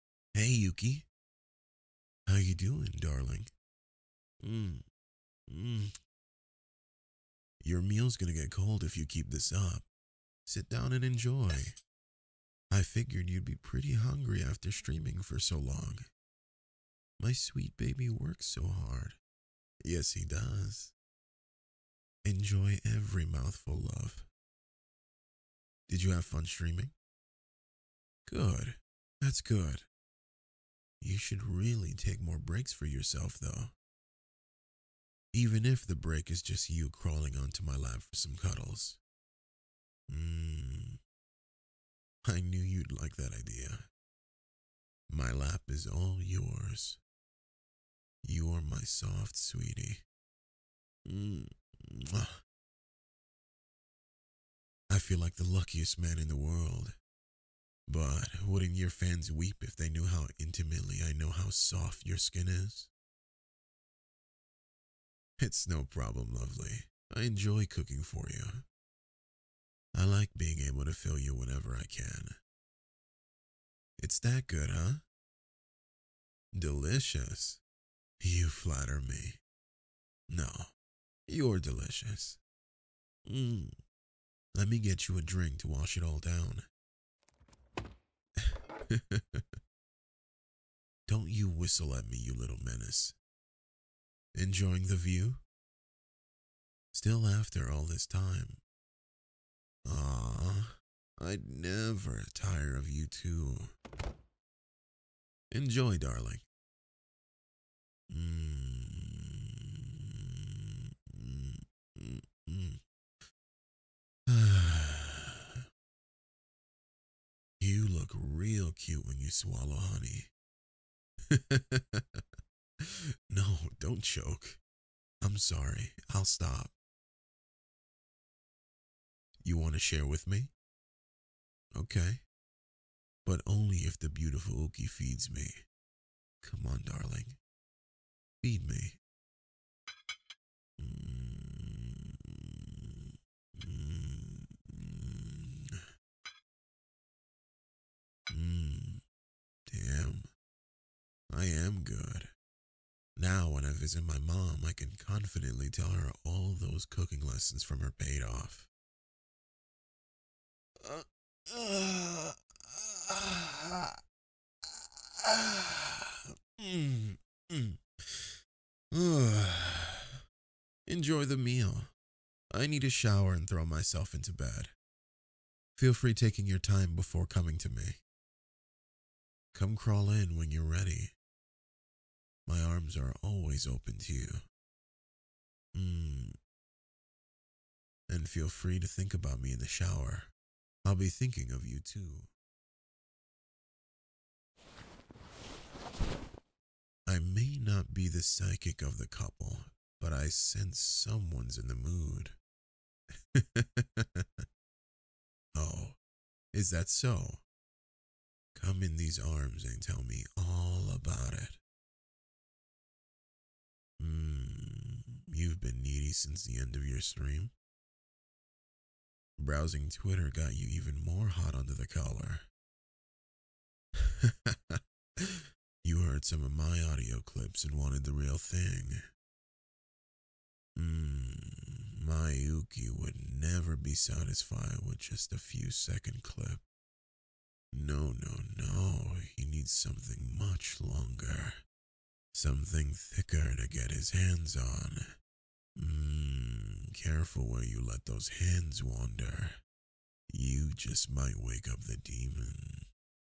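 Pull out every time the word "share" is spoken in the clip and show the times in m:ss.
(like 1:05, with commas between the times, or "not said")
2:09.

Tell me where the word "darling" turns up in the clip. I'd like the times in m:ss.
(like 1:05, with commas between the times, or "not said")
0:02, 1:45, 2:16.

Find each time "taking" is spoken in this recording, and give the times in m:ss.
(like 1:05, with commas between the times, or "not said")
2:56.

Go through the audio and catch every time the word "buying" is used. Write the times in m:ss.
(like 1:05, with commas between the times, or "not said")
not said.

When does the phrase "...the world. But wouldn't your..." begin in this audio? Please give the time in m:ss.
0:56.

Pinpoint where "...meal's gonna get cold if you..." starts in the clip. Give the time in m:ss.
0:07.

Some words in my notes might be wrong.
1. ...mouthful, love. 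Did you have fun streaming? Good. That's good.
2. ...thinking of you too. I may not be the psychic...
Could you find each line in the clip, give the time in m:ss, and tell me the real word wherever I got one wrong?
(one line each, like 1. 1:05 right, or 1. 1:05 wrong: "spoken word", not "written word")
1. 0:23 right
2. 3:11 right.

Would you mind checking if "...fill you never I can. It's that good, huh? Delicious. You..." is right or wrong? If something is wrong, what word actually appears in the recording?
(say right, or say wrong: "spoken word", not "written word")
wrong: "whenever", not "never".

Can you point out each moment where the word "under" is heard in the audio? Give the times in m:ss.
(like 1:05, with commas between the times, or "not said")
3:41.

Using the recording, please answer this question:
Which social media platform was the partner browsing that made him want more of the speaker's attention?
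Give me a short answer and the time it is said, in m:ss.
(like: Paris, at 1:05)
Twitter, at 3:39.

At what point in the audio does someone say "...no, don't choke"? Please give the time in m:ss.
2:03.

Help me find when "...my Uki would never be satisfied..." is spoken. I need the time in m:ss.
3:52.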